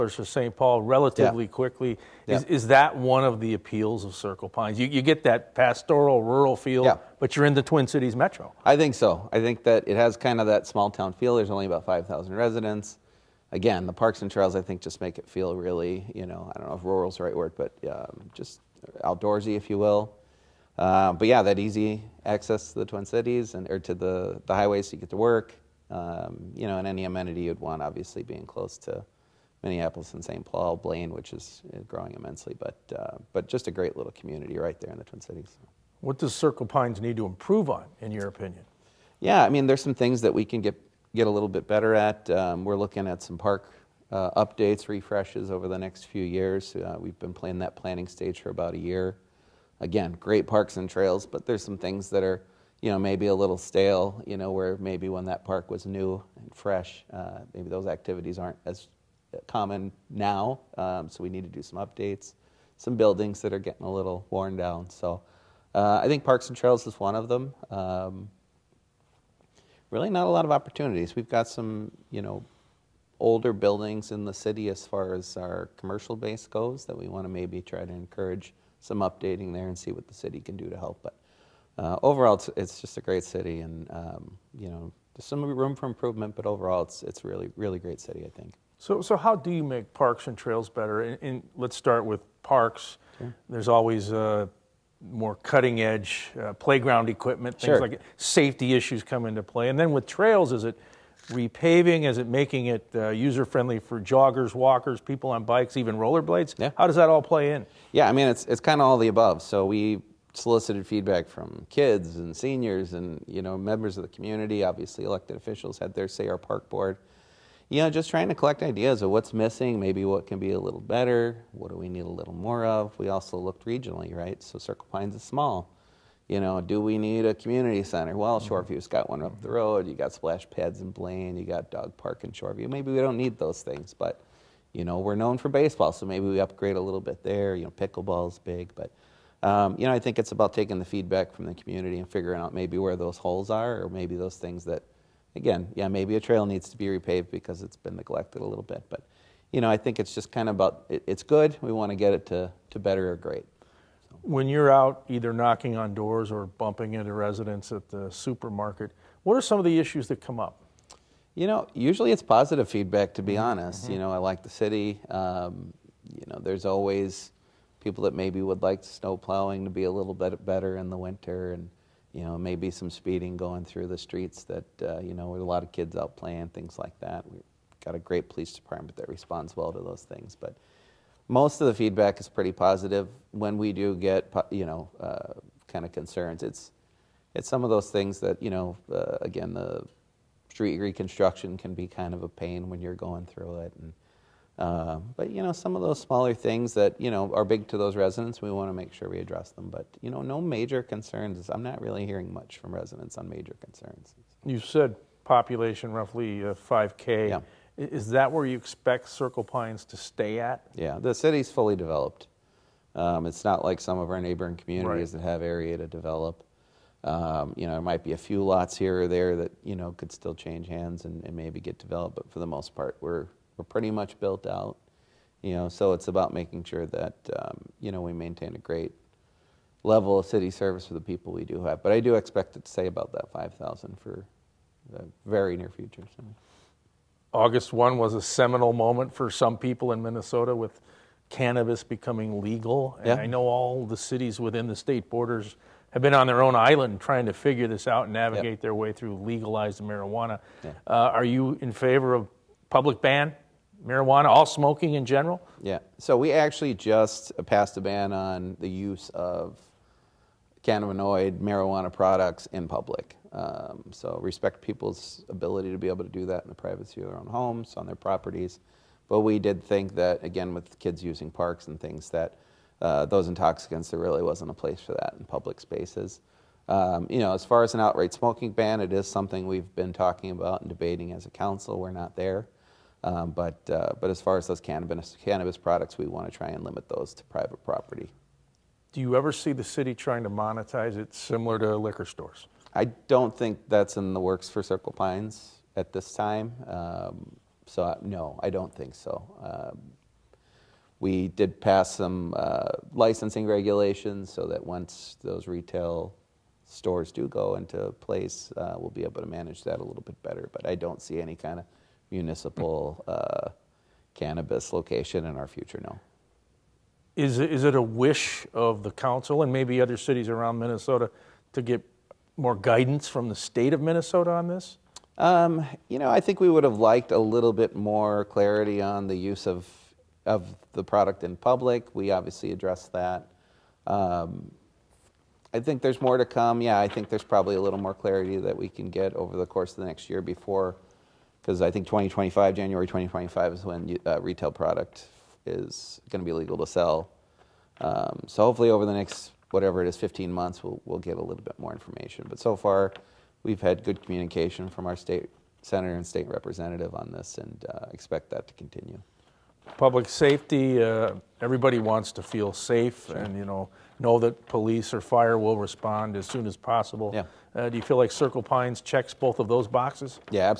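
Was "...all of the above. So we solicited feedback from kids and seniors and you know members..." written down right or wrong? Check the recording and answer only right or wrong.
right.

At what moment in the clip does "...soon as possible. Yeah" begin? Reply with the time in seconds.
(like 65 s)
366 s.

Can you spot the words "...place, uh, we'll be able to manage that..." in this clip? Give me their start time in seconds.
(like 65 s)
308 s.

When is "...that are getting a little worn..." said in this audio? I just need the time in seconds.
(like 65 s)
63 s.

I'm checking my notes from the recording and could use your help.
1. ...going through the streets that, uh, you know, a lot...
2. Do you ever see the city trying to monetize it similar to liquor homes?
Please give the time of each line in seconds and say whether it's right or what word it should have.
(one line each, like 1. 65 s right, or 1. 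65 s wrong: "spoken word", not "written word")
1. 173 s right
2. 288 s wrong: "stores", not "homes".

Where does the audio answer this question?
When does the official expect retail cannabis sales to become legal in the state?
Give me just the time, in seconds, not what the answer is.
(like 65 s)
342 s.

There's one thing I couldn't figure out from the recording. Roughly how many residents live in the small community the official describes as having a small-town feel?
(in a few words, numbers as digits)
5,000.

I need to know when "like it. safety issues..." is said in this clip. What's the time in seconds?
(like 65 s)
97 s.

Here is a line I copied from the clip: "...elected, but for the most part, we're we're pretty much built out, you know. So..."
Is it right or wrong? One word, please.
wrong.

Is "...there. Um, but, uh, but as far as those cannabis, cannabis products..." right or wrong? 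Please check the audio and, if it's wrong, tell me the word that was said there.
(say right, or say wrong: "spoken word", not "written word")
right.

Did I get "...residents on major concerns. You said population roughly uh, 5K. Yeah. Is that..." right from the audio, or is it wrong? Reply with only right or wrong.
right.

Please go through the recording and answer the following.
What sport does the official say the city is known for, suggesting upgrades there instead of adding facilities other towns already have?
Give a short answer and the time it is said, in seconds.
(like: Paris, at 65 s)
Baseball, at 134 s.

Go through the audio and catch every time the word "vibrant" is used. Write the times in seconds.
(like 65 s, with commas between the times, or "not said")
not said.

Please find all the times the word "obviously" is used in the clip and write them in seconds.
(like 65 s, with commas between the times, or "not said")
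27 s, 114 s, 332 s.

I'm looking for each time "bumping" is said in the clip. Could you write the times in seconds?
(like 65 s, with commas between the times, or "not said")
156 s.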